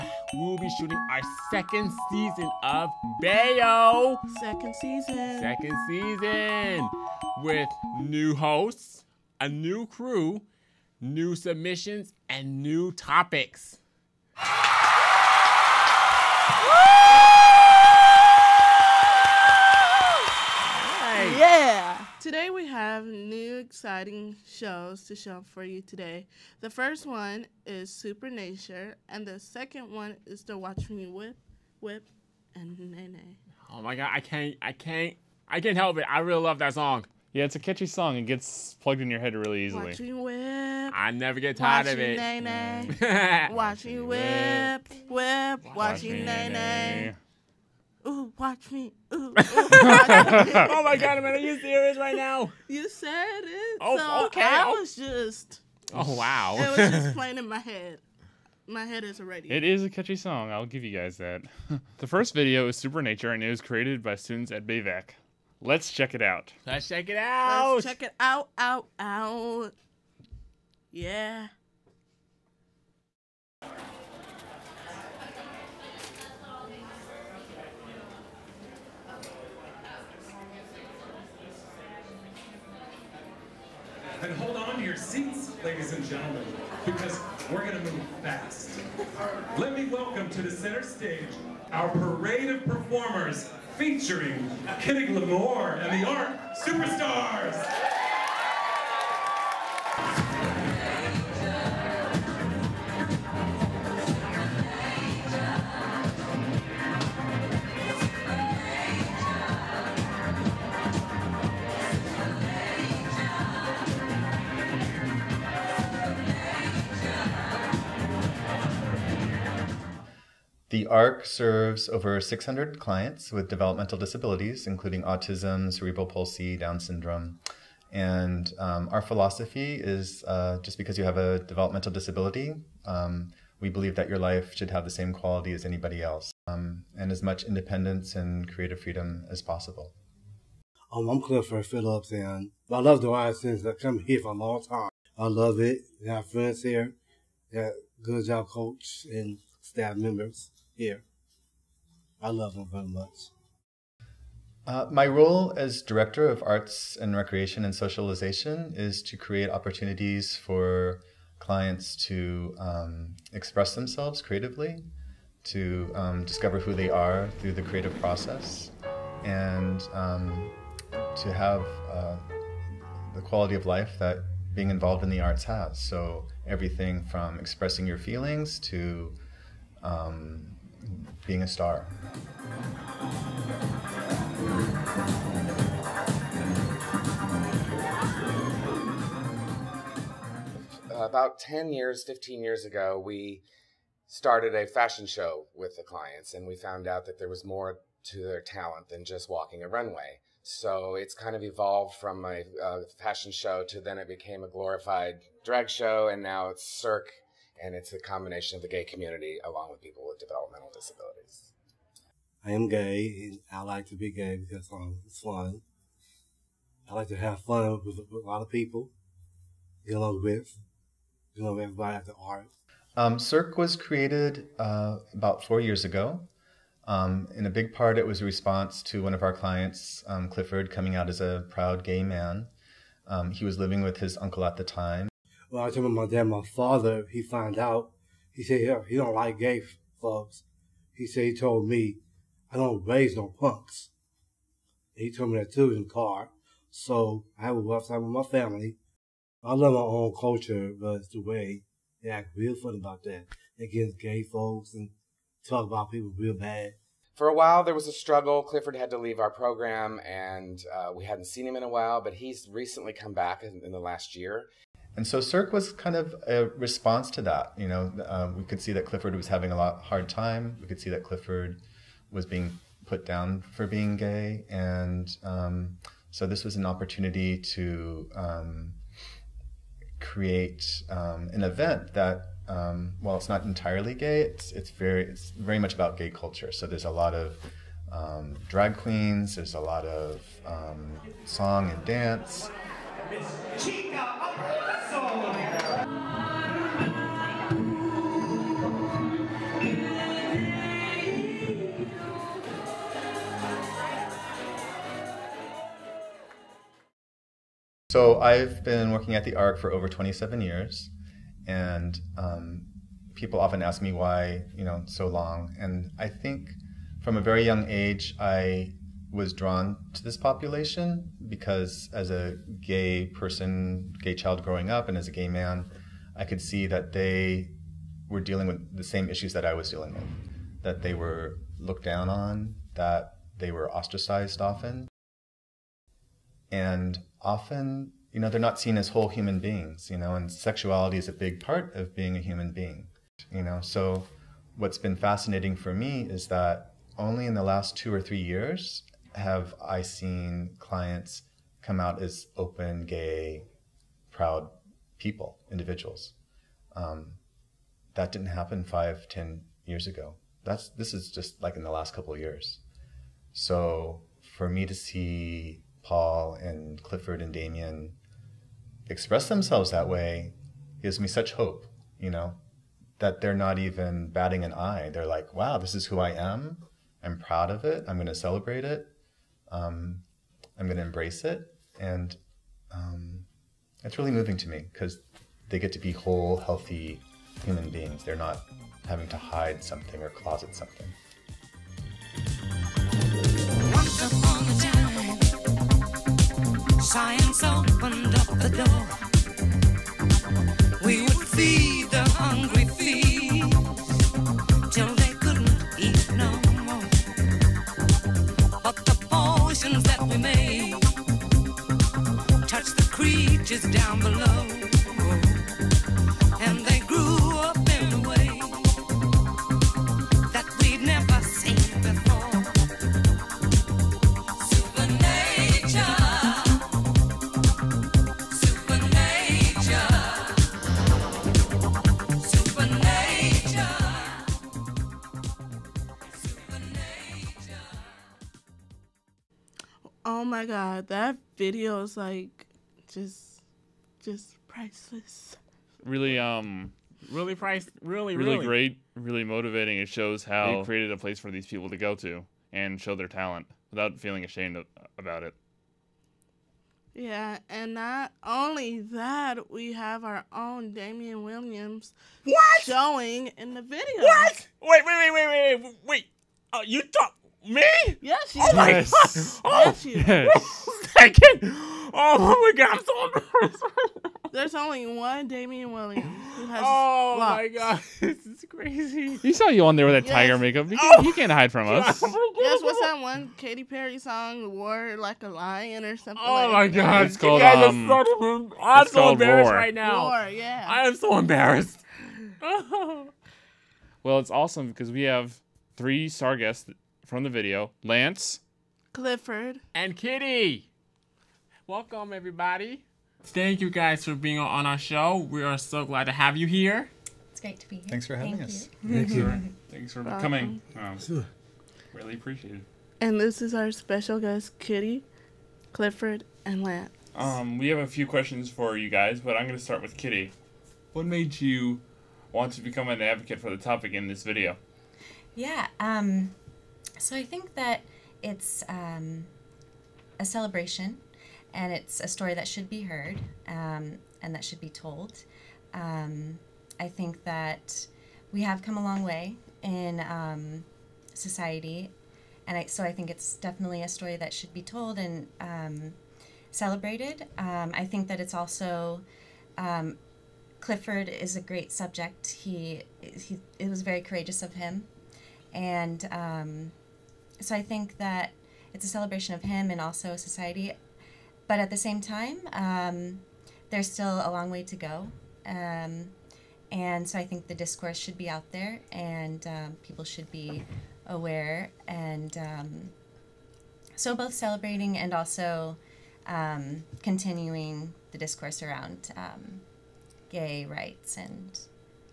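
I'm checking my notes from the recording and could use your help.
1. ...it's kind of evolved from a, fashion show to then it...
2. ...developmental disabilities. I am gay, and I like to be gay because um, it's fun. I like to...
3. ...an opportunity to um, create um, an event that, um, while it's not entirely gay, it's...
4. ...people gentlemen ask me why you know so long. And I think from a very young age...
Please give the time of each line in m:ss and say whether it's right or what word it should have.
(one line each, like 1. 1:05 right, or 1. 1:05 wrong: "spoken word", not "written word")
1. 3:20 right
2. 3:30 right
3. 4:36 right
4. 5:13 wrong: "often", not "gentlemen".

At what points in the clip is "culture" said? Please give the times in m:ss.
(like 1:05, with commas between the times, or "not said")
4:10, 4:46.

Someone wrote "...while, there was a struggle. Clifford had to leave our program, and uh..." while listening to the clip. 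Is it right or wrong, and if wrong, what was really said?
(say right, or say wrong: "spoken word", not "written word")
right.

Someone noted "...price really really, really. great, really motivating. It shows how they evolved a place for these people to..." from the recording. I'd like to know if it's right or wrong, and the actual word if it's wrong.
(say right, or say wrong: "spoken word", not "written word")
wrong: "created", not "evolved".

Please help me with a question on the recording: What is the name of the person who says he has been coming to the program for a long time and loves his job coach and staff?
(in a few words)
Clifford Phillips.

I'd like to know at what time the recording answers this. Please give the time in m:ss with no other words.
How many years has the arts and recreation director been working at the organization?
5:09.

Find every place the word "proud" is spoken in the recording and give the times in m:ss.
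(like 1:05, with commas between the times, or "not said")
3:51, 5:54, 6:17.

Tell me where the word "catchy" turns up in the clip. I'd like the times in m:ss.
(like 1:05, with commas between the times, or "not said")
0:37, 0:59.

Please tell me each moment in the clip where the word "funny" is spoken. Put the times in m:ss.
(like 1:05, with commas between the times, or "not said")
4:12.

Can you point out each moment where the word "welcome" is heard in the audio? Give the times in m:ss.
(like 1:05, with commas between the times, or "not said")
1:29, 8:21, 8:30.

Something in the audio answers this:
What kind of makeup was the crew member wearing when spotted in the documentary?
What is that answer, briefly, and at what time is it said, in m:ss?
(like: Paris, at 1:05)
tiger makeup, at 8:00.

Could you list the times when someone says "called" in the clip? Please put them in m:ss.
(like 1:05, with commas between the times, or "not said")
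8:07.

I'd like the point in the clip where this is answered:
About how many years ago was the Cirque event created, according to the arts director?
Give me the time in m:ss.
3:45.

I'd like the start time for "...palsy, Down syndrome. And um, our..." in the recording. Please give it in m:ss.
2:06.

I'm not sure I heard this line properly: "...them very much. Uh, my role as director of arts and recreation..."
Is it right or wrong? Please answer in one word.
right.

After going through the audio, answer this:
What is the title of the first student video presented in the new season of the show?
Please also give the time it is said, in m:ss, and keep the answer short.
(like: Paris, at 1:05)
Supernature, at 0:27.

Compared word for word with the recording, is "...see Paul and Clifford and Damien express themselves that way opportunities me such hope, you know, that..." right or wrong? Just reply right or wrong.
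wrong.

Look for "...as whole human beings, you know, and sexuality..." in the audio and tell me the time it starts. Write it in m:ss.
5:38.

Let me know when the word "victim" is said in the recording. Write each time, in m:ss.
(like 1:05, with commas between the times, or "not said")
not said.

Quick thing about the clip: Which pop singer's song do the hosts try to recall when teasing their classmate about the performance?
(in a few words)
Katy Perry.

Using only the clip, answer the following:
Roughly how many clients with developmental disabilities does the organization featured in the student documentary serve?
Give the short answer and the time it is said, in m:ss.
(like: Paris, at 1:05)
over 600, at 2:01.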